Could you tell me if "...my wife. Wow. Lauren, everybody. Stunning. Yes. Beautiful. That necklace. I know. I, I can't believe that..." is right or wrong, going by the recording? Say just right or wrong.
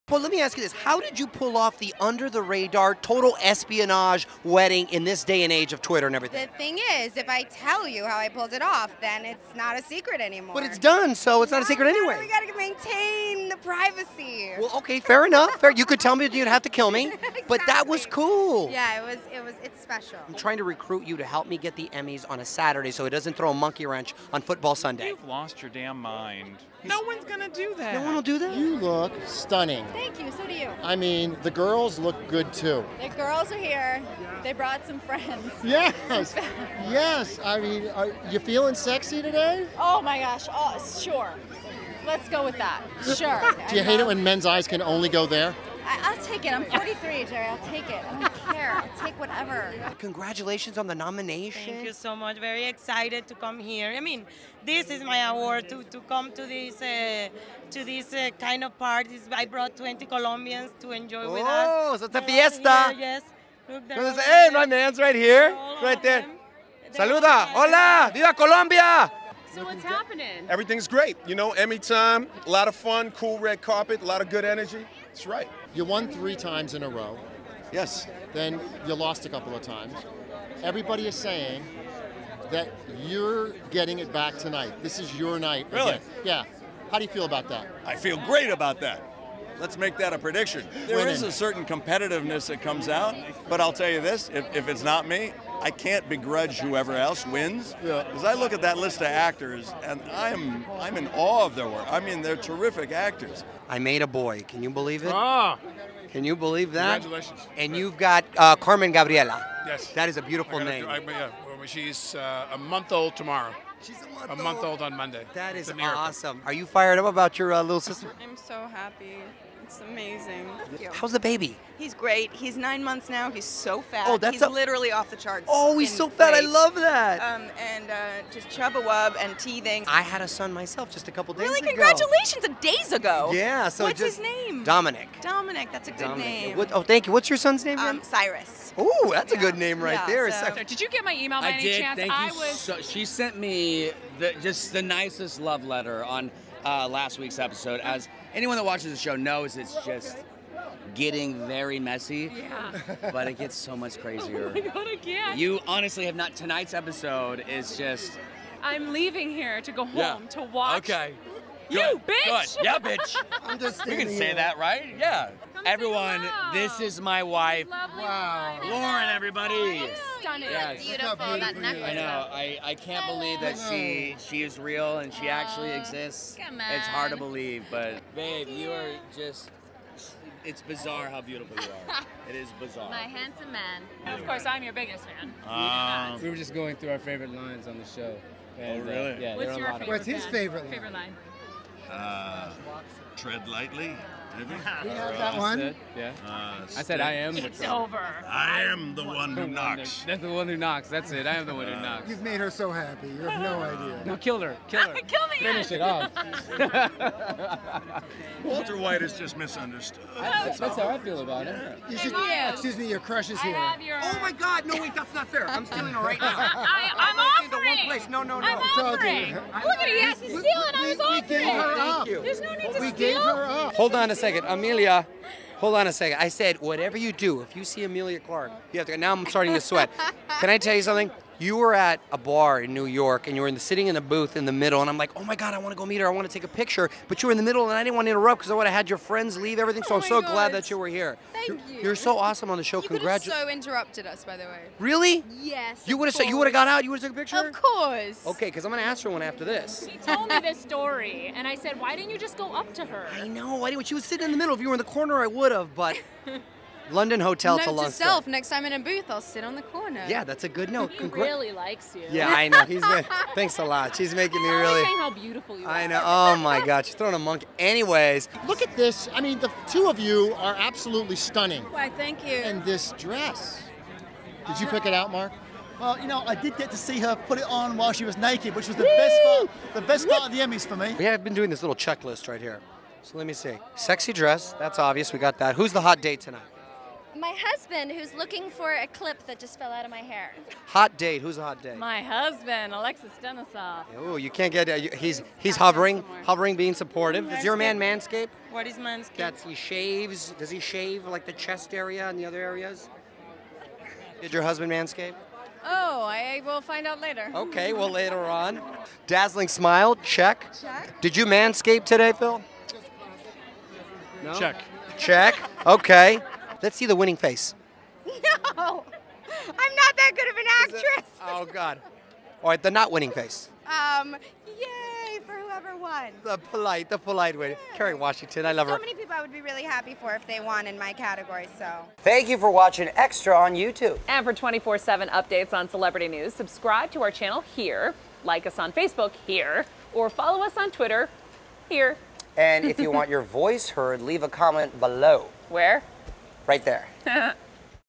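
right.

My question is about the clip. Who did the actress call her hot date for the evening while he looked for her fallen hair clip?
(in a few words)
Alexis Denisof.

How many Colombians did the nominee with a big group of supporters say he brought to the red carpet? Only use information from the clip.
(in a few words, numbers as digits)
20.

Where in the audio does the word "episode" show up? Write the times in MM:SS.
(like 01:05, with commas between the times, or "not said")
02:27, 02:36.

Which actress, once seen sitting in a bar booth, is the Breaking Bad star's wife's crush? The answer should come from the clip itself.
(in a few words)
Emilia Clarke.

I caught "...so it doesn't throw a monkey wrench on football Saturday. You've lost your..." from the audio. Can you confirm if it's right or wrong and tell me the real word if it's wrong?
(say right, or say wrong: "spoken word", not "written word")
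wrong: "Sunday", not "Saturday".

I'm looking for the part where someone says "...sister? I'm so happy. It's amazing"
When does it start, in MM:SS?
01:57.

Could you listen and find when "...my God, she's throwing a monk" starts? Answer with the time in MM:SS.
04:26.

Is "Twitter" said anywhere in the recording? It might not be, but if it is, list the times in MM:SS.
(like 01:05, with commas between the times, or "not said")
00:05, 05:40.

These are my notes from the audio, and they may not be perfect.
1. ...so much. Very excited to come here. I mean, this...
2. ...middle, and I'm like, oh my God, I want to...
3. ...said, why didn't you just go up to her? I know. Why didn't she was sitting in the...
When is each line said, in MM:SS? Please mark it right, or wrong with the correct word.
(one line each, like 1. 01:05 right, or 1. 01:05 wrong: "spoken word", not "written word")
1. 00:51 right
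2. 03:54 right
3. 04:11 right.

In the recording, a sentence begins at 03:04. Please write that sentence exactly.
And of course, I'm your biggest fan.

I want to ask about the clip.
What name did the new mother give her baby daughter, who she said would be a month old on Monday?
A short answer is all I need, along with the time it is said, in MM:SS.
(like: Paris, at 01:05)
Carmen Gabriela, at 01:48.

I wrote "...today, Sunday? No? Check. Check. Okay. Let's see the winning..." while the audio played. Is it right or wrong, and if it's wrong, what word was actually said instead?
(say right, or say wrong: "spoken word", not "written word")
wrong: "Phil", not "Sunday".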